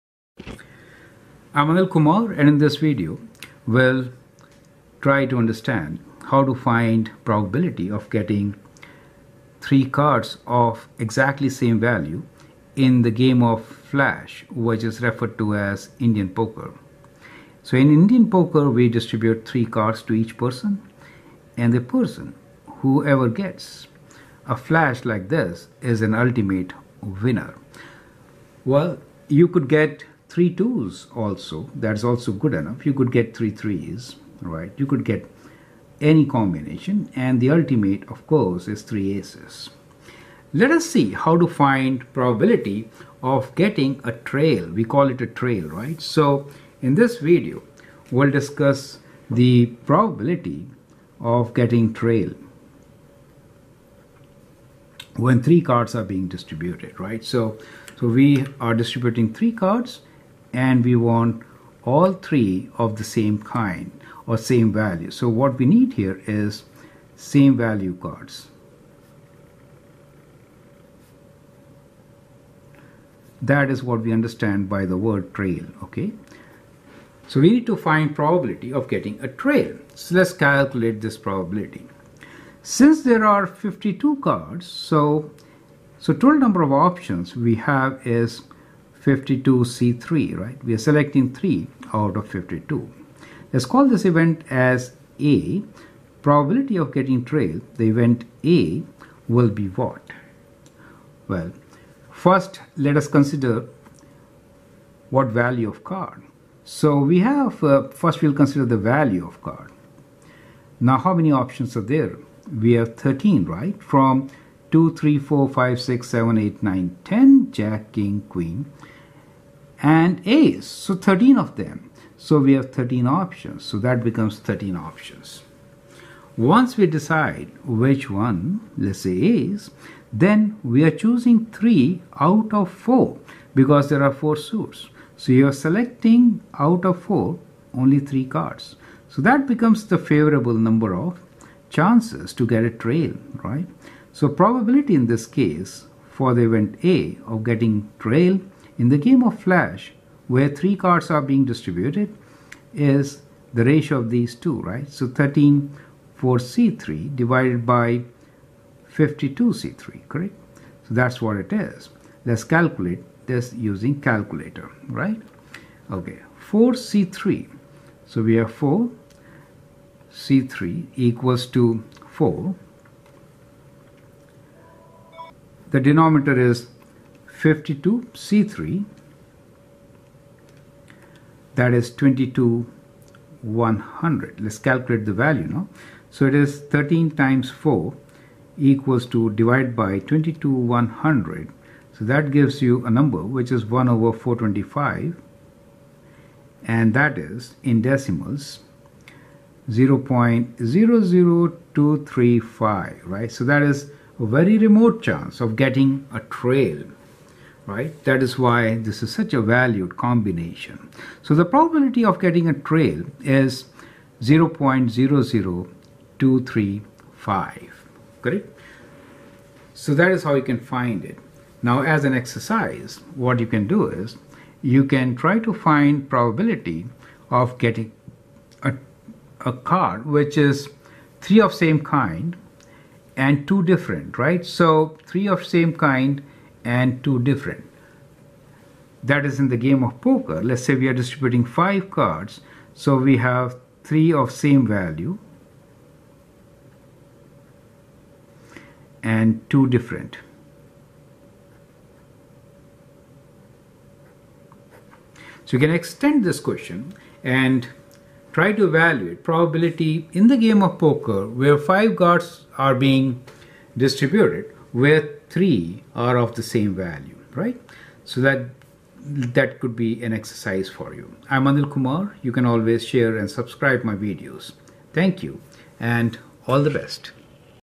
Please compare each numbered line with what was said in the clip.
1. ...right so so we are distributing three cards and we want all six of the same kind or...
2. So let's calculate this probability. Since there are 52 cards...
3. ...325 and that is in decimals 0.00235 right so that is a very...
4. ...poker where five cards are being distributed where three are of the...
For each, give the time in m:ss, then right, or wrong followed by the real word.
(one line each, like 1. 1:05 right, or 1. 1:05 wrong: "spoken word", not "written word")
1. 0:57 wrong: "three", not "six"
2. 1:19 right
3. 3:14 wrong: "425", not "325"
4. 4:20 right.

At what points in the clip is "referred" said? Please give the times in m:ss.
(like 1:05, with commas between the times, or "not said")
0:15.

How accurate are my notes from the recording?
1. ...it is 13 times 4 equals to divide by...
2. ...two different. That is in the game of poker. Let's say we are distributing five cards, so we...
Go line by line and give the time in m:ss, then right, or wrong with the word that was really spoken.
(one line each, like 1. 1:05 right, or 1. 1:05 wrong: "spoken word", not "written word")
1. 3:06 right
2. 3:57 right.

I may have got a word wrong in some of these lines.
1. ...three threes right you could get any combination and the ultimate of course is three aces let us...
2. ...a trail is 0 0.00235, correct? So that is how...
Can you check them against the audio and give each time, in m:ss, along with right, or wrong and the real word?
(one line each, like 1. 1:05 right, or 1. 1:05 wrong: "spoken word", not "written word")
1. 0:33 right
2. 3:32 right.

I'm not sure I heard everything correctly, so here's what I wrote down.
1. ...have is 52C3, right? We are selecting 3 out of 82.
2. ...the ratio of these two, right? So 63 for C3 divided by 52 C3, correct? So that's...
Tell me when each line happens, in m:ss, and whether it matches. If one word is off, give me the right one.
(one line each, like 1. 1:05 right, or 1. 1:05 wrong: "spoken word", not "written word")
1. 1:27 wrong: "52", not "82"
2. 2:33 wrong: "13", not "63".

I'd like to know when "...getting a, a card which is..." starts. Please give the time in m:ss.
3:47.